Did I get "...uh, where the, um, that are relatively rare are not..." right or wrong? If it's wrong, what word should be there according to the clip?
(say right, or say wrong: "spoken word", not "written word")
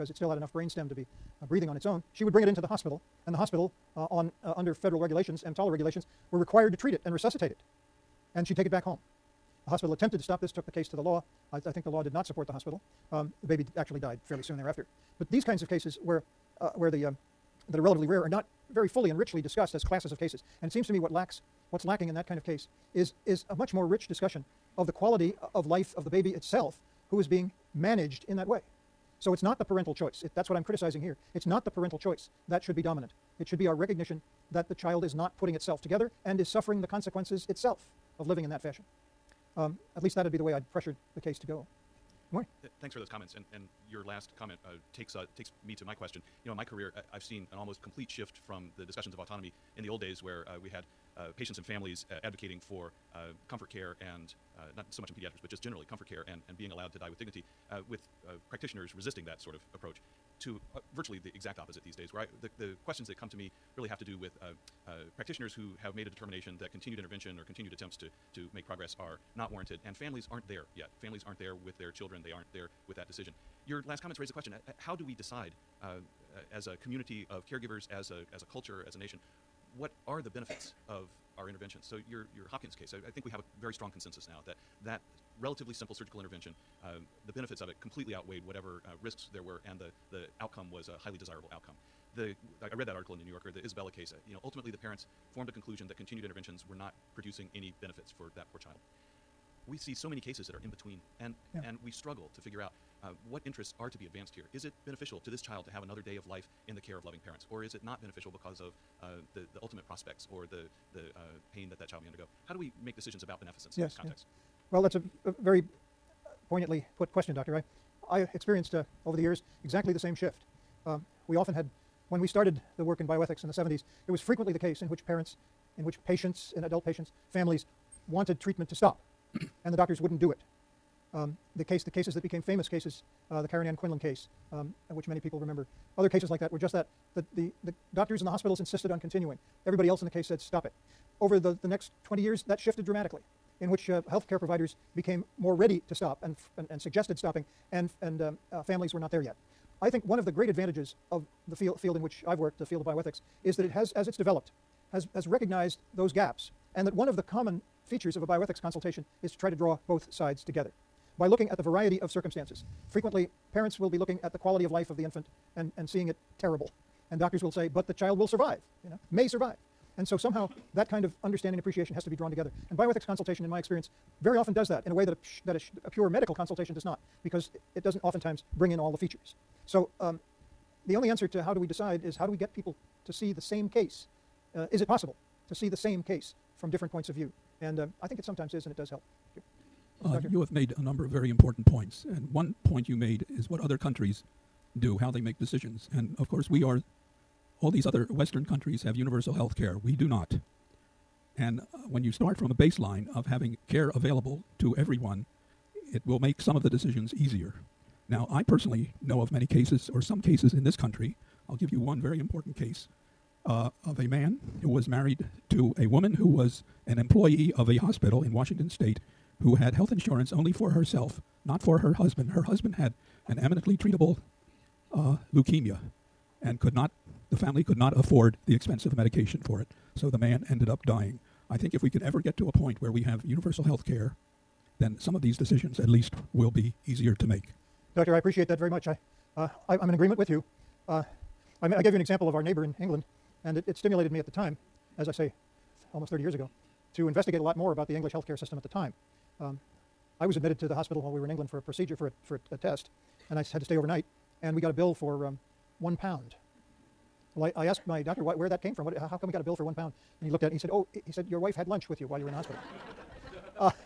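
right.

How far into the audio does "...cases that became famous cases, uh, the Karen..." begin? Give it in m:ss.
2:11.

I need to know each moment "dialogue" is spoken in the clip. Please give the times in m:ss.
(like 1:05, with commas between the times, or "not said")
not said.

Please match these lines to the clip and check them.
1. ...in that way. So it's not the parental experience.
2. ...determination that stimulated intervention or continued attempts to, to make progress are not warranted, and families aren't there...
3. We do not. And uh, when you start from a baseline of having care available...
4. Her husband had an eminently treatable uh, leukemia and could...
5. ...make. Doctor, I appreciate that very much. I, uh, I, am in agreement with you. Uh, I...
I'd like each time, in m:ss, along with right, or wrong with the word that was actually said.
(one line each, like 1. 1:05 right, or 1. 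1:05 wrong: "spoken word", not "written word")
1. 0:28 wrong: "choice", not "experience"
2. 1:06 wrong: "continued", not "stimulated"
3. 3:19 right
4. 3:42 right
5. 3:57 right.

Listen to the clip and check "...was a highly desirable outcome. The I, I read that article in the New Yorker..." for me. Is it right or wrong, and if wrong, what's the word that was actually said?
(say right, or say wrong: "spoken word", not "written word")
right.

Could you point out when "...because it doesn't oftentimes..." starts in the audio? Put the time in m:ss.
2:57.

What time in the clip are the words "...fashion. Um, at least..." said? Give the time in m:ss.
0:38.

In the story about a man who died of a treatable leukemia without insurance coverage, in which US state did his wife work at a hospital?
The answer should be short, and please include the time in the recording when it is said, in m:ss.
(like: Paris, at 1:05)
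Washington, at 3:38.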